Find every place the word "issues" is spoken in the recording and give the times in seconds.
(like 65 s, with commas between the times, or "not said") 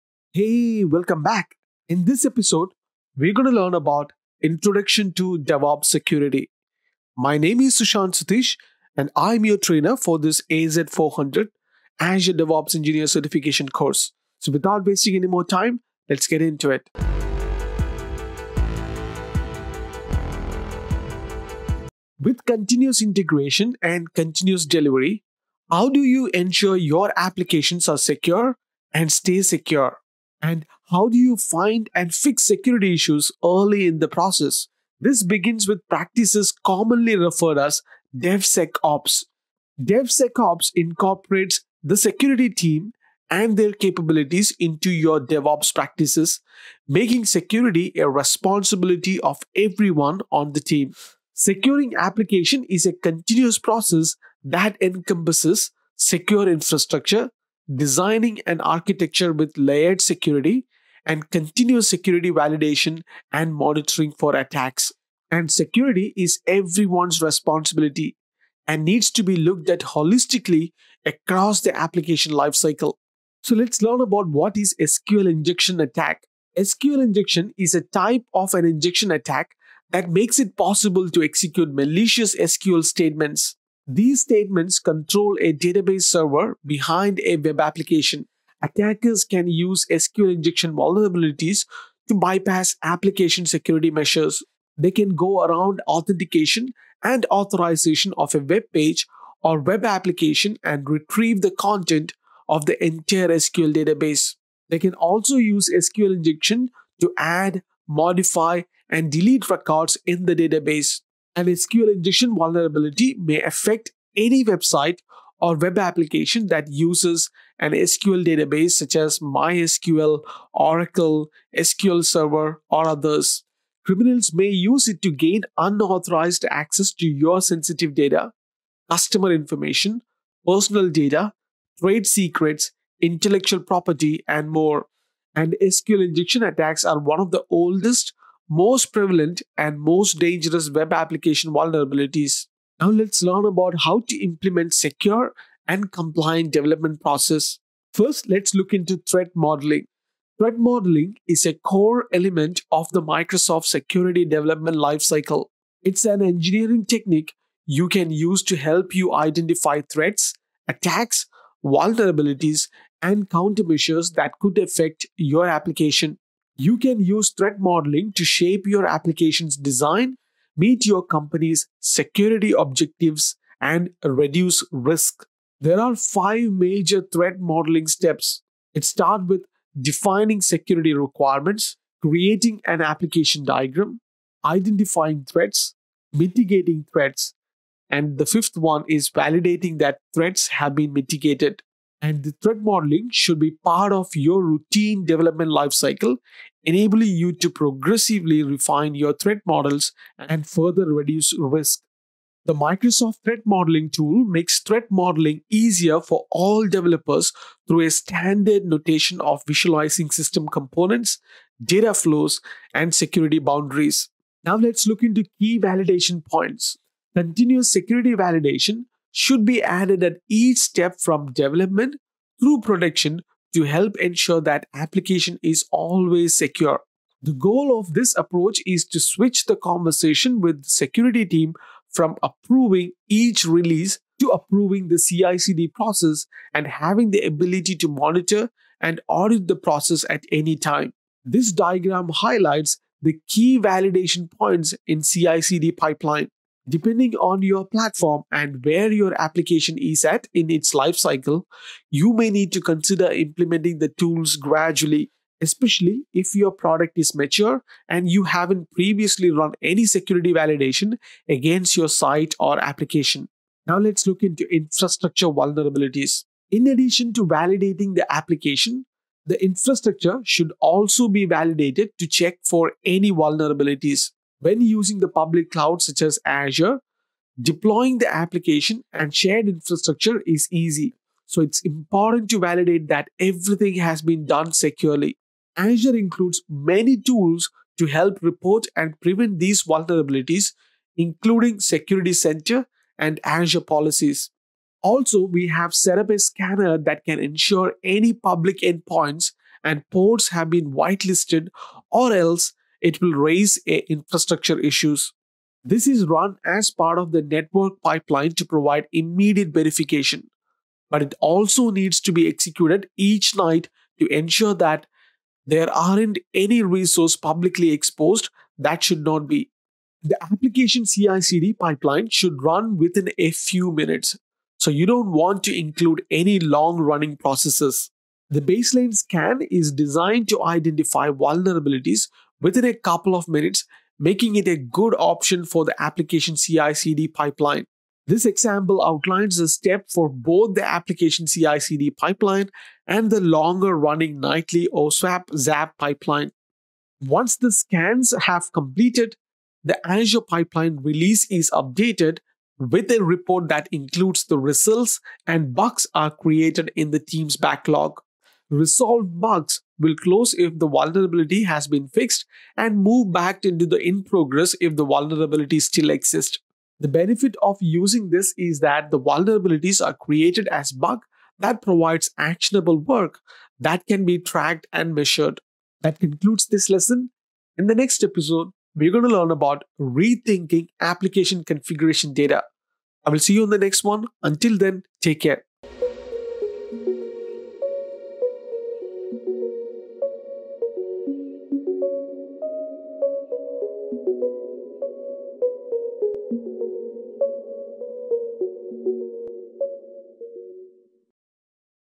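32 s, 304 s.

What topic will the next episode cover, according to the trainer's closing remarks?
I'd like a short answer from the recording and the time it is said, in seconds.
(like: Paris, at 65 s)
Rethinking application configuration data, at 379 s.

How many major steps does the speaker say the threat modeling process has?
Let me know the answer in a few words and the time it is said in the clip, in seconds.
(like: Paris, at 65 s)
5, at 175 s.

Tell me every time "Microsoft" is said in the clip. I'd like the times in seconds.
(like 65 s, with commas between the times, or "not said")
153 s, 202 s.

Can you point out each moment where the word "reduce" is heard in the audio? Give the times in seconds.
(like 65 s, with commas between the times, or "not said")
174 s, 200 s.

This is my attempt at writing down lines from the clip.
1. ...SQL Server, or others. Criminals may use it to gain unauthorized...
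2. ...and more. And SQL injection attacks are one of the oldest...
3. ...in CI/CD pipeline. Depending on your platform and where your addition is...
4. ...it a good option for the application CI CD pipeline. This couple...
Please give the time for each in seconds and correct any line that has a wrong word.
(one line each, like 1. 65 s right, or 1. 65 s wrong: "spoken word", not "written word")
1. 121 s right
2. 134 s right
3. 244 s wrong: "application", not "addition"
4. 334 s wrong: "example", not "couple".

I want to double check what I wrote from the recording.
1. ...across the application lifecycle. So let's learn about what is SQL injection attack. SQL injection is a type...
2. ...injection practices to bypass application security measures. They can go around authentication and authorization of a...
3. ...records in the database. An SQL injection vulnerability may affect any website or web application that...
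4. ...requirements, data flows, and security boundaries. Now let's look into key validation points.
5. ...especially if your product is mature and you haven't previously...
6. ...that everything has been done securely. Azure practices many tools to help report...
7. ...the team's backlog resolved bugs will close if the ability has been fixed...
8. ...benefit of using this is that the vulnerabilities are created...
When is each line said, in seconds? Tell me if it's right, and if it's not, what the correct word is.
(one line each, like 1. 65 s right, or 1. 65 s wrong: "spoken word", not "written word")
1. 71 s right
2. 90 s wrong: "vulnerabilities", not "practices"
3. 109 s right
4. 210 s wrong: "components", not "requirements"
5. 255 s right
6. 282 s wrong: "includes", not "practices"
7. 356 s wrong: "vulnerability", not "ability"
8. 366 s right.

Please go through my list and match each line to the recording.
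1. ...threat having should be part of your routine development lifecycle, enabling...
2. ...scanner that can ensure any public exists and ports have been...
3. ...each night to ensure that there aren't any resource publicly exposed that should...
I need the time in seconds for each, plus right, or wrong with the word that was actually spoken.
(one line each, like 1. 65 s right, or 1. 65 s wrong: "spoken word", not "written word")
1. 192 s wrong: "modeling", not "having"
2. 296 s wrong: "endpoints", not "exists"
3. 312 s right.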